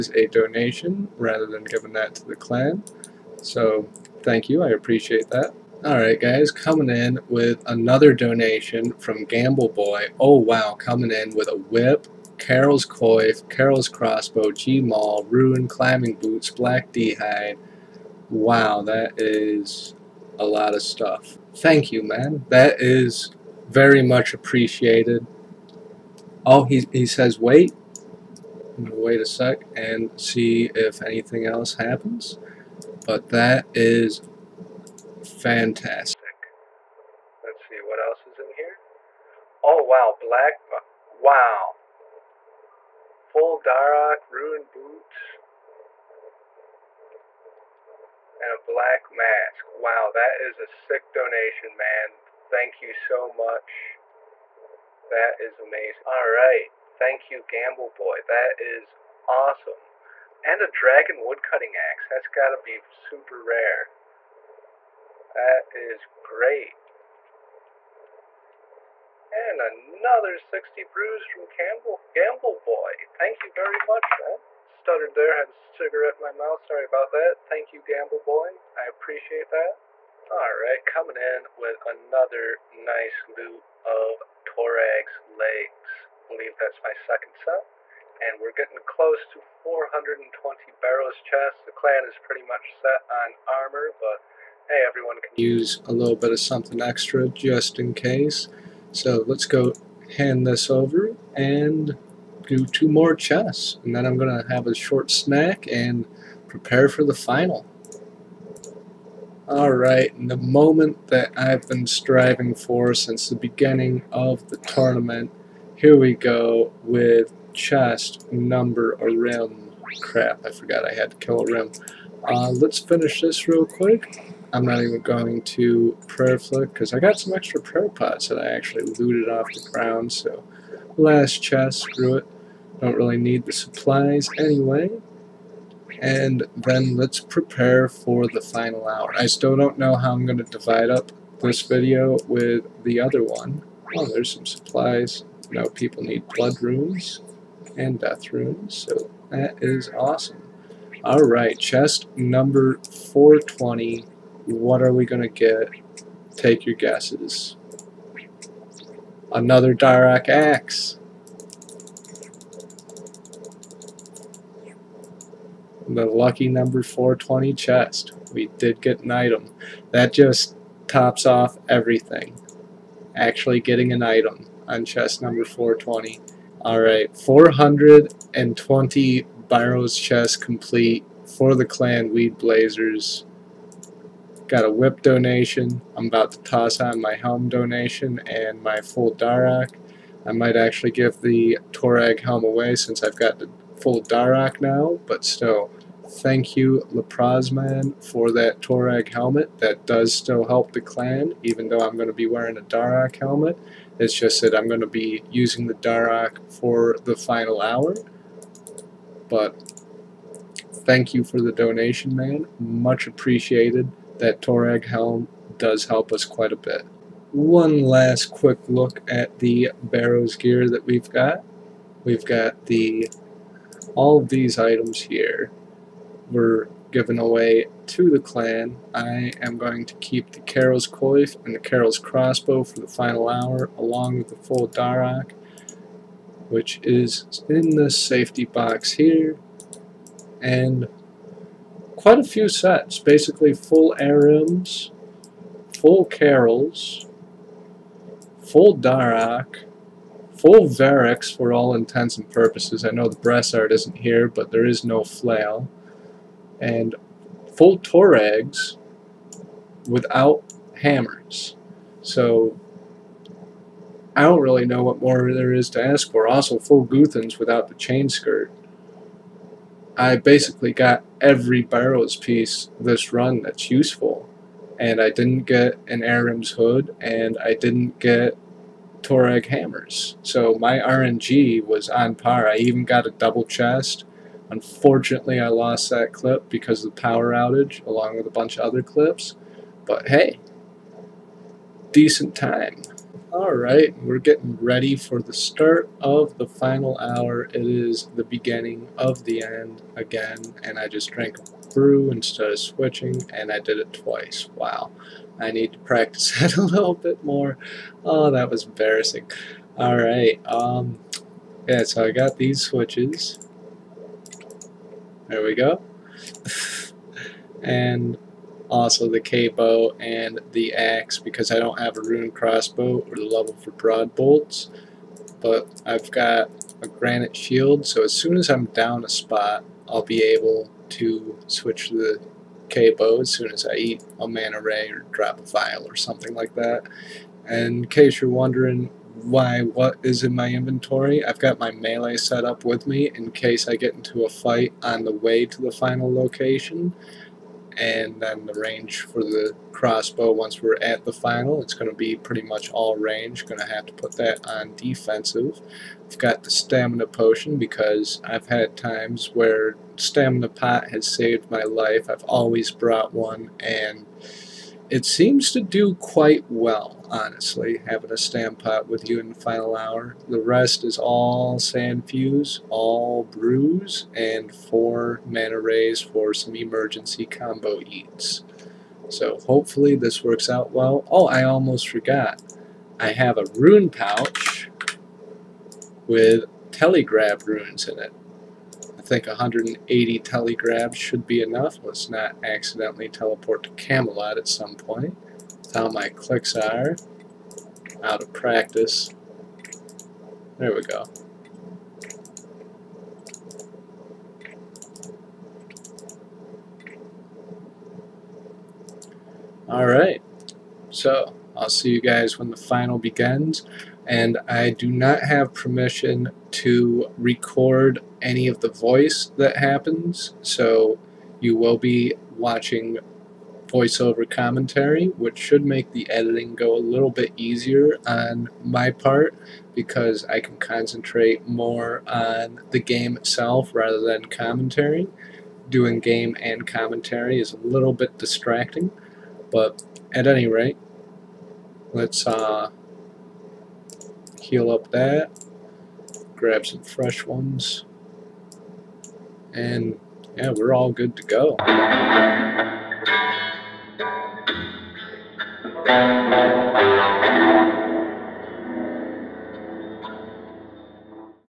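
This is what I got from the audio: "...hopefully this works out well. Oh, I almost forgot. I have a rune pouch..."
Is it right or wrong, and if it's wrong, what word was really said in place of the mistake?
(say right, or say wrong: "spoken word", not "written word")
right.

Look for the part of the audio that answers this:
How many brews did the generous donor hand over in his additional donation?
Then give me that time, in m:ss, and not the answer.
1:10.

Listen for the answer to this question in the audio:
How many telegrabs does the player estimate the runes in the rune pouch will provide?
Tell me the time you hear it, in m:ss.
6:29.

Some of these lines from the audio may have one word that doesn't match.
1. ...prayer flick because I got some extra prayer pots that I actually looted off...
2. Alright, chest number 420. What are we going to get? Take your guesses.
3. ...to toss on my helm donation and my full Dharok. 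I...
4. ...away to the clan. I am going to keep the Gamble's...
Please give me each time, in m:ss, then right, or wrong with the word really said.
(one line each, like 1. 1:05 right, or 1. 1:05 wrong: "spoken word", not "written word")
1. 2:06 right
2. 2:31 right
3. 3:06 right
4. 3:47 wrong: "Karil", not "Gamble".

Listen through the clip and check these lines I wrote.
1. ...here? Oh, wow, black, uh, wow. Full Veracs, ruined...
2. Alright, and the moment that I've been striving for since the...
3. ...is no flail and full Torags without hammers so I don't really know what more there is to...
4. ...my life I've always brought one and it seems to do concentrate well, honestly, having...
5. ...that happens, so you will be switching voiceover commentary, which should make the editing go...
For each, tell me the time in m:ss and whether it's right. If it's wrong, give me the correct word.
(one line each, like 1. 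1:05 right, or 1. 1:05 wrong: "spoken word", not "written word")
1. 0:38 wrong: "Dharok", not "Veracs"
2. 1:49 right
3. 4:14 right
4. 6:01 wrong: "quite", not "concentrate"
5. 6:59 wrong: "watching", not "switching".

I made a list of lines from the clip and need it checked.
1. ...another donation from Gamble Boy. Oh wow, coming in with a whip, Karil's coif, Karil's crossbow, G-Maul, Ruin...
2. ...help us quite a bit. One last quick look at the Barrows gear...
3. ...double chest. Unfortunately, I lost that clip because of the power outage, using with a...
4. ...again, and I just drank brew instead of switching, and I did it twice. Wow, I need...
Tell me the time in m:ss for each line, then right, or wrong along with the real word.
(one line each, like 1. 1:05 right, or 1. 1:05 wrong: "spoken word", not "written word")
1. 0:07 right
2. 3:35 right
3. 4:43 wrong: "along", not "using"
4. 4:59 right.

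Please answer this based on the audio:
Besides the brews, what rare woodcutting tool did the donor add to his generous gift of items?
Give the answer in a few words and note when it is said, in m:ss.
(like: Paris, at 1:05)
dragon woodcutting axe, at 1:00.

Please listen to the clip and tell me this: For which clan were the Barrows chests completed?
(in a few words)
Weed Blazers.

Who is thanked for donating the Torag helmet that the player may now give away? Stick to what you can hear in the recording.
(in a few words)
Leprosman.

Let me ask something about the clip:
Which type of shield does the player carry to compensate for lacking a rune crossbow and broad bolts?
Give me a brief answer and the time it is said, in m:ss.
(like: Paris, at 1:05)
granite shield, at 5:26.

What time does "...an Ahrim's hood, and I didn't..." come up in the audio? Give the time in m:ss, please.
4:35.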